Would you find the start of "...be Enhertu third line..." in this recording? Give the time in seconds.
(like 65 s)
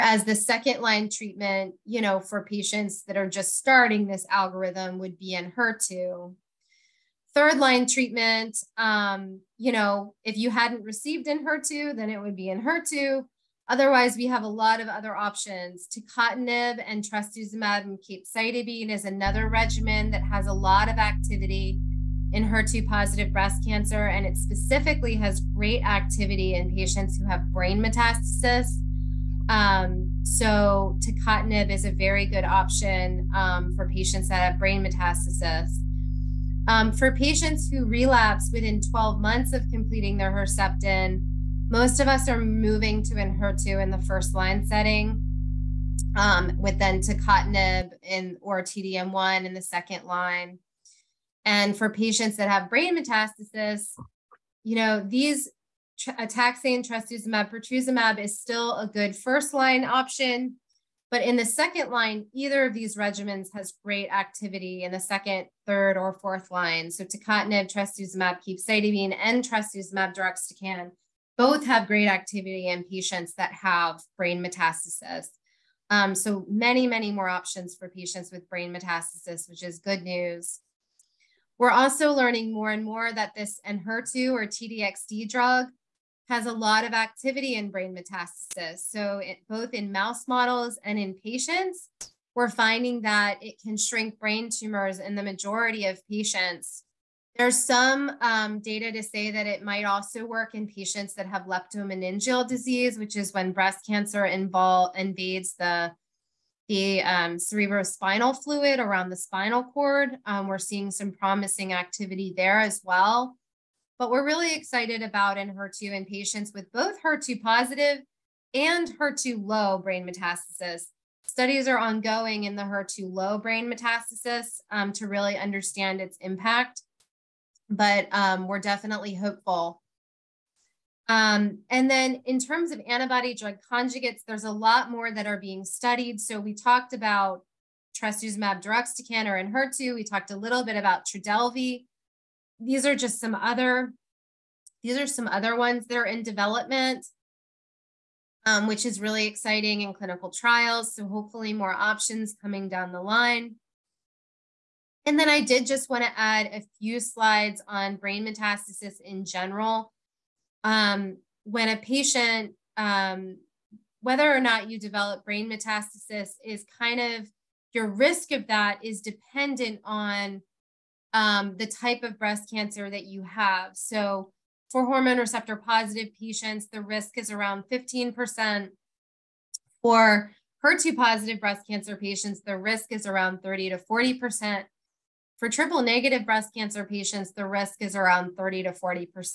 5 s.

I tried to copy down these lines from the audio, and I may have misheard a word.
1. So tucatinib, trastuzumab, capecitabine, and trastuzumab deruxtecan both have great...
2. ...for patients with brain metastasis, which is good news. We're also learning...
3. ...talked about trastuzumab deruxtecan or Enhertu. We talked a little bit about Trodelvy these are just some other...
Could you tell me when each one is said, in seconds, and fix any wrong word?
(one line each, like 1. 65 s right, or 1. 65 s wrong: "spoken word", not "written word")
1. 66 s right
2. 77 s right
3. 136 s right.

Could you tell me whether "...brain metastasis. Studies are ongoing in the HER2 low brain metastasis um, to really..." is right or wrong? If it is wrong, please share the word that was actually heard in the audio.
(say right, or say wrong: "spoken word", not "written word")
right.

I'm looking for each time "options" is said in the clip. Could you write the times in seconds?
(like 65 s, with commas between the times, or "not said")
15 s, 32 s, 59 s, 77 s, 151 s.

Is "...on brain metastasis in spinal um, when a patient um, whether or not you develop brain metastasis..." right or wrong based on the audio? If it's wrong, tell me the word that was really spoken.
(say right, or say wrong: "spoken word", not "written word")
wrong: "general", not "spinal".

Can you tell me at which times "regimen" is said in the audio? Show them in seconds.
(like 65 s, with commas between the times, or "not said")
19 s, 62 s.